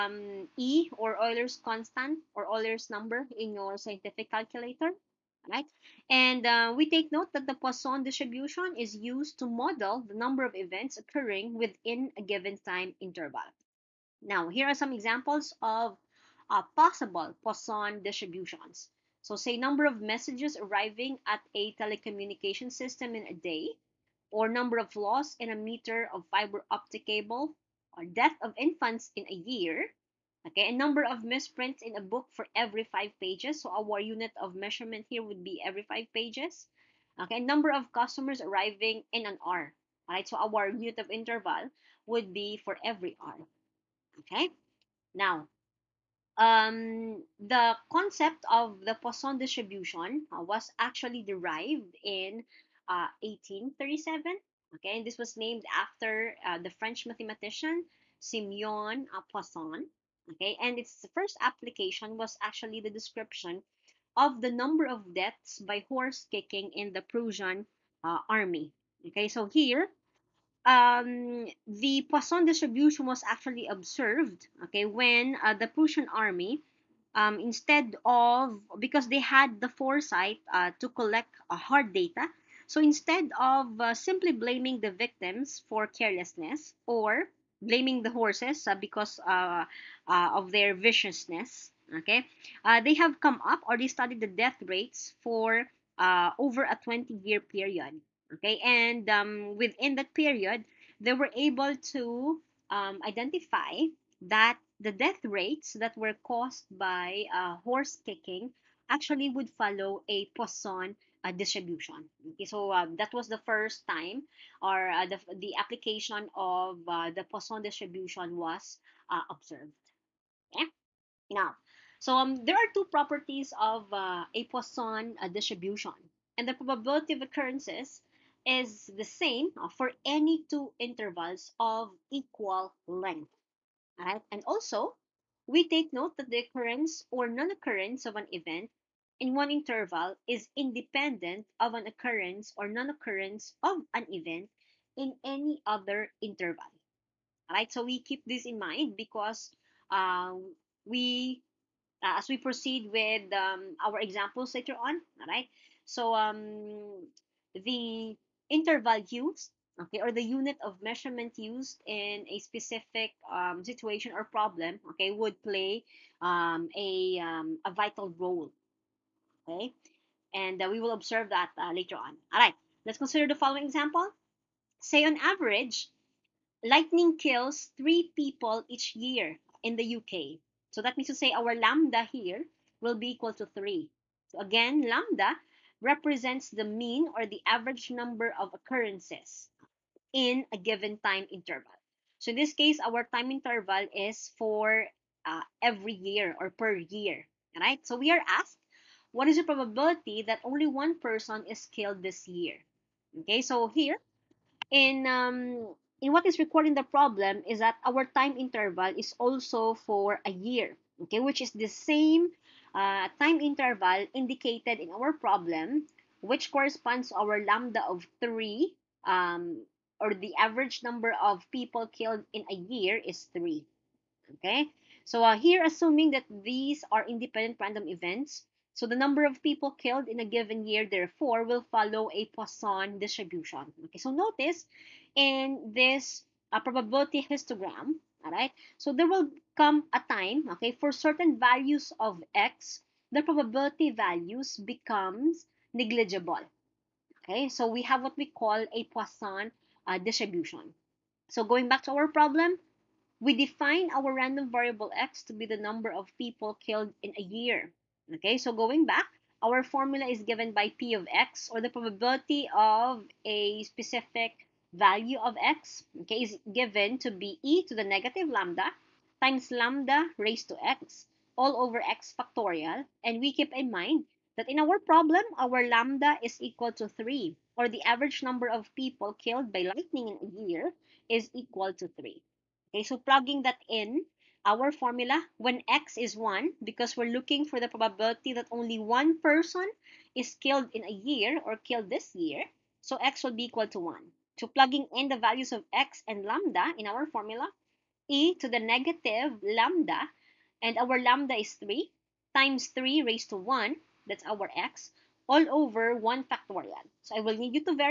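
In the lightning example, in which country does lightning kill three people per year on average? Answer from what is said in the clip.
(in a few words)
UK.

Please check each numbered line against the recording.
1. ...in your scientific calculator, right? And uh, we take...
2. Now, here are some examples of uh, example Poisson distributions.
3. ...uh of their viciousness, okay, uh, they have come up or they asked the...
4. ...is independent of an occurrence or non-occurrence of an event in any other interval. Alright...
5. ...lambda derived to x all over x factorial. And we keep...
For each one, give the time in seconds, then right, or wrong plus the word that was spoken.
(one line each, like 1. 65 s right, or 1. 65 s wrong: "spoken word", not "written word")
1. 3 s right
2. 14 s wrong: "possible", not "example"
3. 90 s wrong: "studied", not "asked"
4. 140 s right
5. 269 s wrong: "raised", not "derived".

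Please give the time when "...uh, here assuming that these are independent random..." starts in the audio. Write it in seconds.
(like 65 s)
225 s.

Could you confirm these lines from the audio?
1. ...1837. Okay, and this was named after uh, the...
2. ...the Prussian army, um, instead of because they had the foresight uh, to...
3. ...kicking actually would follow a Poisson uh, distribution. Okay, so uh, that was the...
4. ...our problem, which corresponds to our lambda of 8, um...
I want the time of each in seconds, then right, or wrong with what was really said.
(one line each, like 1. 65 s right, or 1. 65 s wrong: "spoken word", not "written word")
1. 53 s right
2. 75 s right
3. 108 s right
4. 214 s wrong: "3", not "8".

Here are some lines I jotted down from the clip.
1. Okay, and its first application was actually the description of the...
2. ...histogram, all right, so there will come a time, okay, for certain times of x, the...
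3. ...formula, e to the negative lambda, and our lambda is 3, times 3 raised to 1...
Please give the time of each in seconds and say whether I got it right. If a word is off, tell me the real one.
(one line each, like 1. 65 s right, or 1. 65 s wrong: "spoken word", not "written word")
1. 60 s right
2. 237 s wrong: "values", not "times"
3. 297 s right.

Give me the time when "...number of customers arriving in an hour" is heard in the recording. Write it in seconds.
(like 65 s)
37 s.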